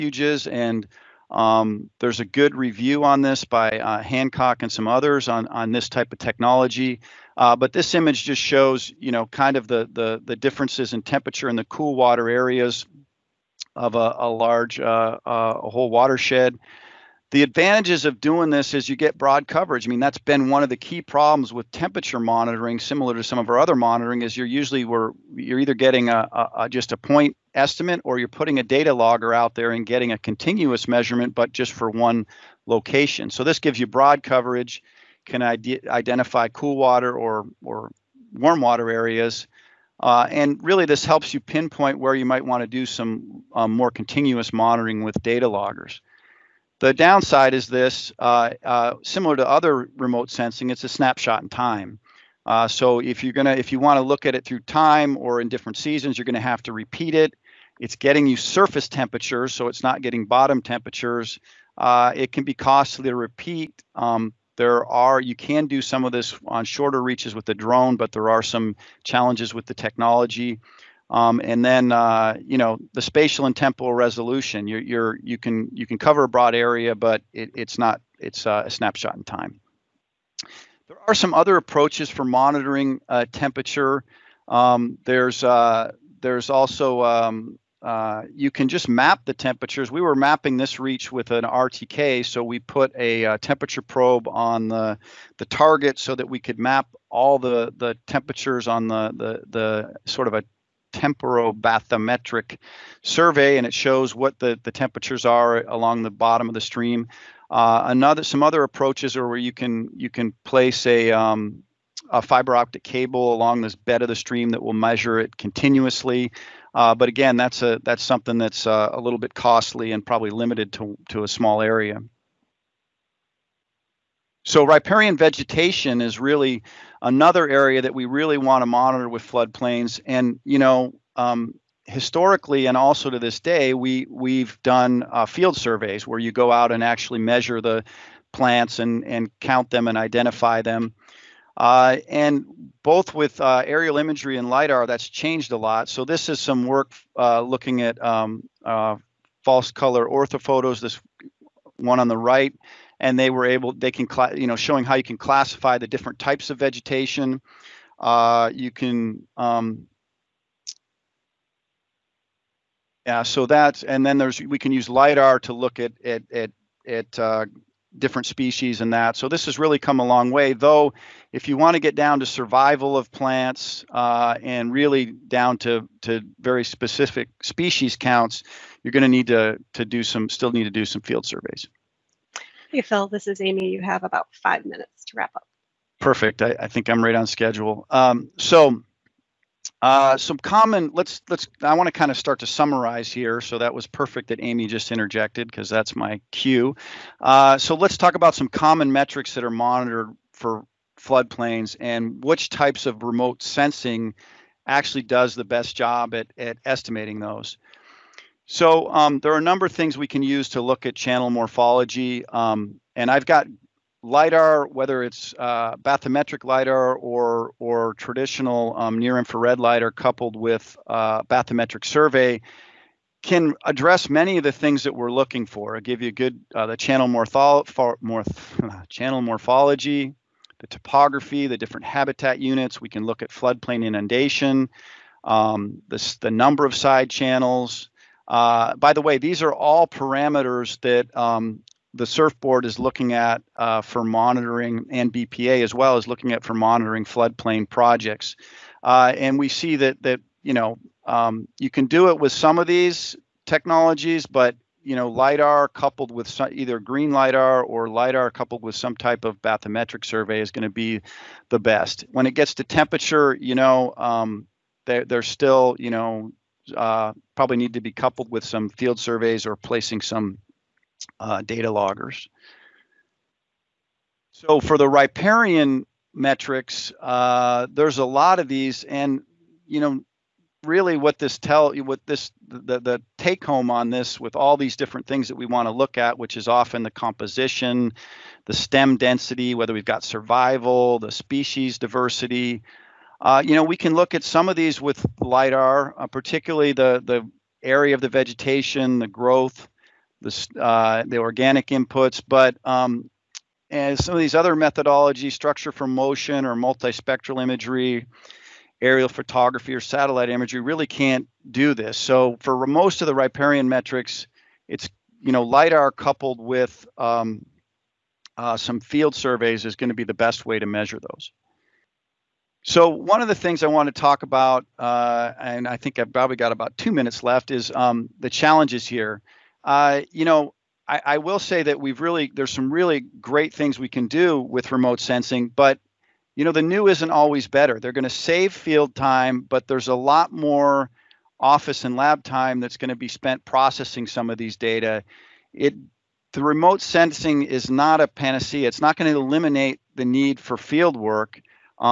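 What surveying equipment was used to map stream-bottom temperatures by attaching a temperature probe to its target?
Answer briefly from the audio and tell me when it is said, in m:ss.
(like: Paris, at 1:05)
RTK, at 1:31.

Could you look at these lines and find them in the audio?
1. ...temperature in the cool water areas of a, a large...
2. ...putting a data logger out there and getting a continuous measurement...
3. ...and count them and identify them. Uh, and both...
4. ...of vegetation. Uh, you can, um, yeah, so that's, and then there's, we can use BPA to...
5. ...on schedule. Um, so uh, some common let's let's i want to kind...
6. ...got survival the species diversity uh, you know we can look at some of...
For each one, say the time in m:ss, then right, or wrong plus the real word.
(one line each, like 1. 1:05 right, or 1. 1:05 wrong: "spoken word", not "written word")
1. 0:11 right
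2. 0:28 right
3. 2:19 right
4. 2:36 wrong: "LIDAR", not "BPA"
5. 3:07 right
6. 4:49 right.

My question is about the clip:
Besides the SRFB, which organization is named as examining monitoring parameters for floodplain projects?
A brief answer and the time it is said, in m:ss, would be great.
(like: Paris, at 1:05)
BPA, at 4:05.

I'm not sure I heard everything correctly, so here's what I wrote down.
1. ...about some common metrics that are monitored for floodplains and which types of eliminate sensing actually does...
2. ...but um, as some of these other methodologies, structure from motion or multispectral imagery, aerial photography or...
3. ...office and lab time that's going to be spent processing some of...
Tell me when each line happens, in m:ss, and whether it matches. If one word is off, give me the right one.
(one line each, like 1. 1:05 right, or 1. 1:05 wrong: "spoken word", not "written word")
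1. 3:18 wrong: "remote", not "eliminate"
2. 5:02 right
3. 5:41 right.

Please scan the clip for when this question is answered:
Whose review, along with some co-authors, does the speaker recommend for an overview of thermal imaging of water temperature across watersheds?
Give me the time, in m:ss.
0:04.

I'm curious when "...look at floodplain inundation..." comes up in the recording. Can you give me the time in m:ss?
3:53.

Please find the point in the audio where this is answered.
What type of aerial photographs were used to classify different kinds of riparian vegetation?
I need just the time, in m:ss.
2:29.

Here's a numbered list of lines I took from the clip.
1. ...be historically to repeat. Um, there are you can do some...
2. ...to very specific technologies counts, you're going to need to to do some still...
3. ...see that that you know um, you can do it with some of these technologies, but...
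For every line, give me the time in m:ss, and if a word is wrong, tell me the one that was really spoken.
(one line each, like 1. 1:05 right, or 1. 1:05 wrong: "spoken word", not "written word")
1. 1:02 wrong: "costly", not "historically"
2. 2:56 wrong: "species", not "technologies"
3. 4:09 right.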